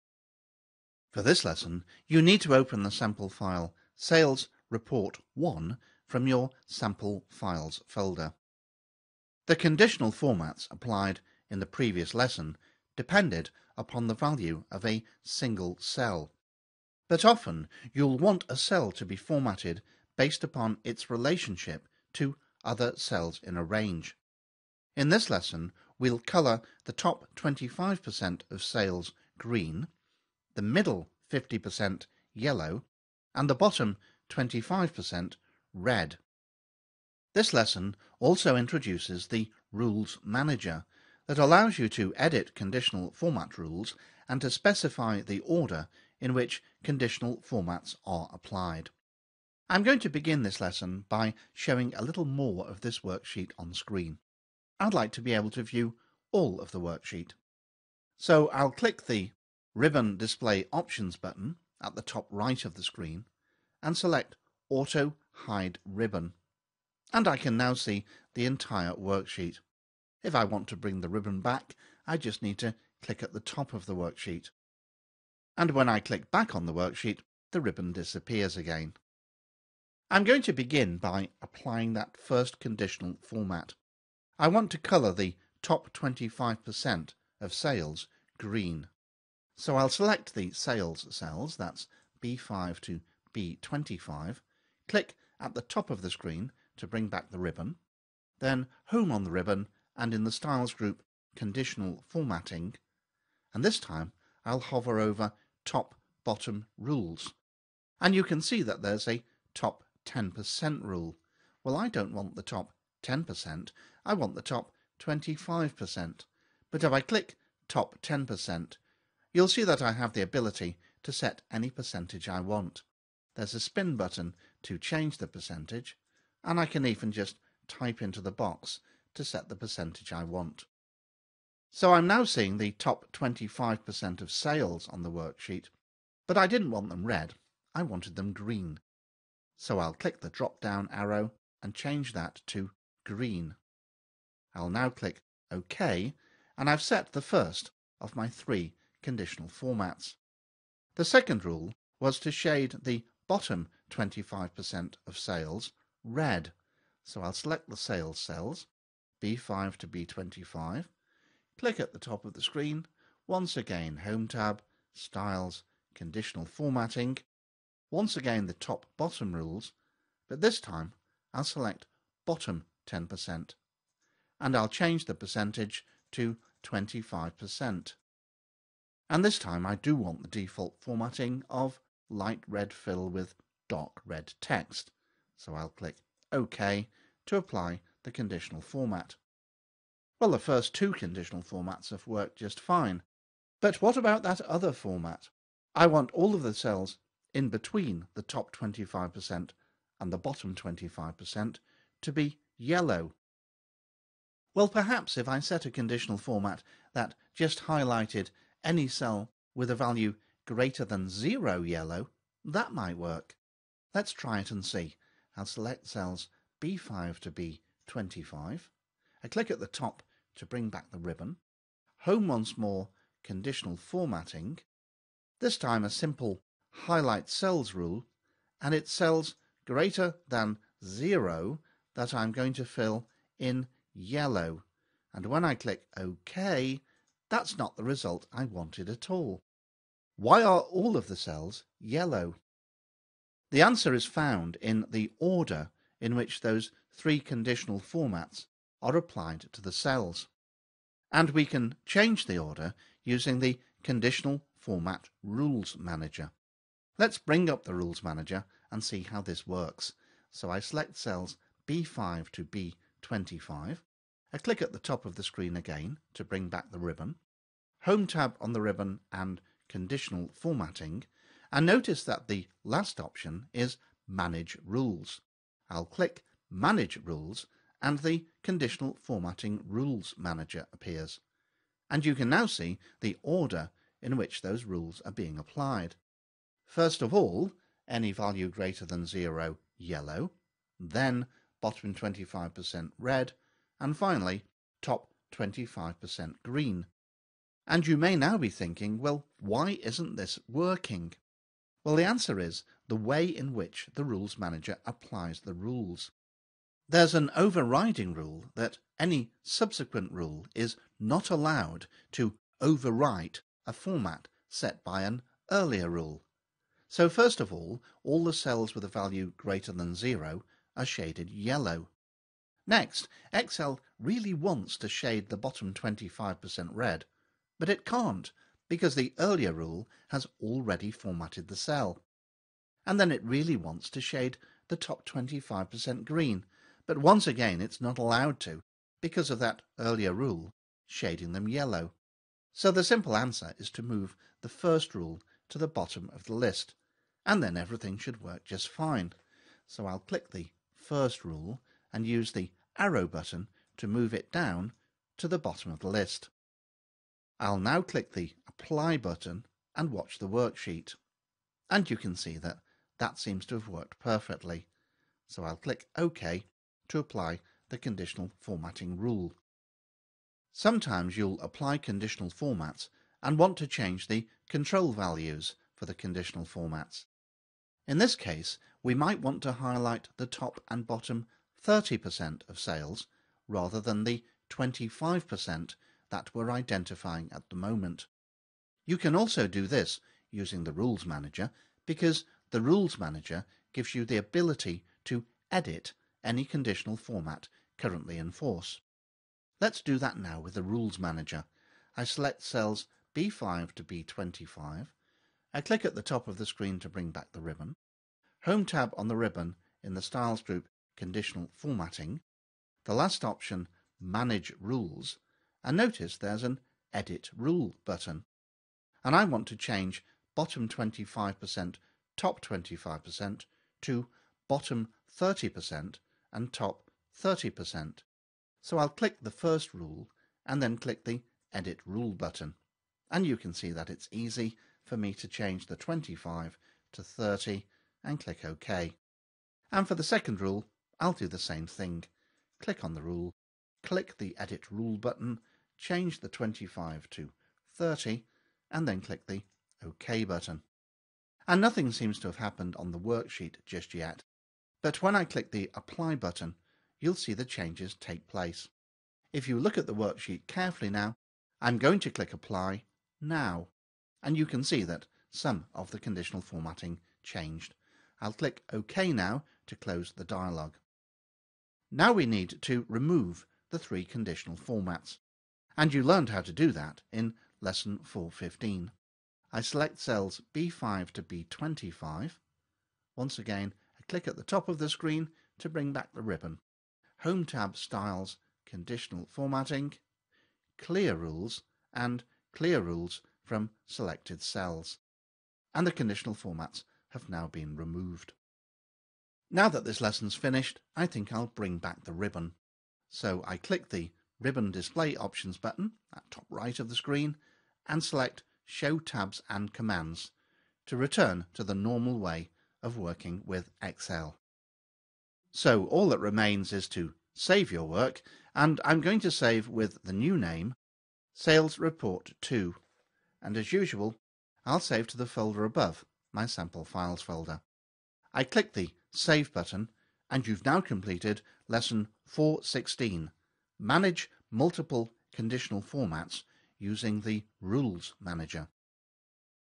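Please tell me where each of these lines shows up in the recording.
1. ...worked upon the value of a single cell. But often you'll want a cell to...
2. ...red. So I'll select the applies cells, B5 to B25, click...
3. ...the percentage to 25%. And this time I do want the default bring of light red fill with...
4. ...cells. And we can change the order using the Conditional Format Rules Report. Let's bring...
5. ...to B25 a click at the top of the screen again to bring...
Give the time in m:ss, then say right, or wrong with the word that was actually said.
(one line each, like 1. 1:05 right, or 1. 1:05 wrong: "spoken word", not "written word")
1. 0:12 wrong: "depended", not "worked"
2. 2:36 wrong: "sales", not "applies"
3. 2:55 wrong: "formatting", not "bring"
4. 4:09 wrong: "Manager", not "Report"
5. 4:22 right.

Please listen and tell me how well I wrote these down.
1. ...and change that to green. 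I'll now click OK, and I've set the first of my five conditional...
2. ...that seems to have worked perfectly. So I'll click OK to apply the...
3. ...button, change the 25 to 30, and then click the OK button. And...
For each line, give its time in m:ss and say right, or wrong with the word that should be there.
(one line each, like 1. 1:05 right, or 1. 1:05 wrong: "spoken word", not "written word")
1. 2:21 wrong: "three", not "five"
2. 6:02 right
3. 7:24 right.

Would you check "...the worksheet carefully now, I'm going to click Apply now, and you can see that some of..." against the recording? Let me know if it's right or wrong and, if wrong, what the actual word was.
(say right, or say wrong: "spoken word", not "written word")
right.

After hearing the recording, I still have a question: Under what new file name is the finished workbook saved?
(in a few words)
Sales Report 2.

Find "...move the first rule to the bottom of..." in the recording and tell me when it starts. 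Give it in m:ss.
5:43.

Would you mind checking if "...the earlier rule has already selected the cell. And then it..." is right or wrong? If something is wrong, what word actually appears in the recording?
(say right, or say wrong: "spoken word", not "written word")
wrong: "formatted", not "selected".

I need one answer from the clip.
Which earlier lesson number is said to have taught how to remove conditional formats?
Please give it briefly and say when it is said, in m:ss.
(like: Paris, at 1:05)
415, at 7:57.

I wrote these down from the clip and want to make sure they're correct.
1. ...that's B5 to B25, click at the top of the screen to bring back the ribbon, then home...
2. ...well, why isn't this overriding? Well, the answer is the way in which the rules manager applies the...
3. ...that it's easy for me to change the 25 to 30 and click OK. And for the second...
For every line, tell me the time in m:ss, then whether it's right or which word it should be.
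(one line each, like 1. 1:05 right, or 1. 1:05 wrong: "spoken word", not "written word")
1. 1:31 right
2. 4:58 wrong: "working", not "overriding"
3. 7:13 right.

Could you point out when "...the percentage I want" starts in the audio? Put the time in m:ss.
2:09.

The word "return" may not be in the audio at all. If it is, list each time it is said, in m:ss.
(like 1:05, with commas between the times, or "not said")
8:30.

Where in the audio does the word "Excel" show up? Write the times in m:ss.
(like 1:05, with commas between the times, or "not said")
5:23, 8:33.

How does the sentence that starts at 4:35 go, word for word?
I'll click Manage Rules and the Conditional Formatting Rules Manager appears.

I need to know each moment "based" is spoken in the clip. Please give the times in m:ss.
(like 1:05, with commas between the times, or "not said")
0:20.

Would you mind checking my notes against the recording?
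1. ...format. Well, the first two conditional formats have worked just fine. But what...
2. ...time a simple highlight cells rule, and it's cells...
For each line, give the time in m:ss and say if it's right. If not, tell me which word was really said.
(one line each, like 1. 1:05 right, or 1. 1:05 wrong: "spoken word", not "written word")
1. 3:08 right
2. 3:45 right.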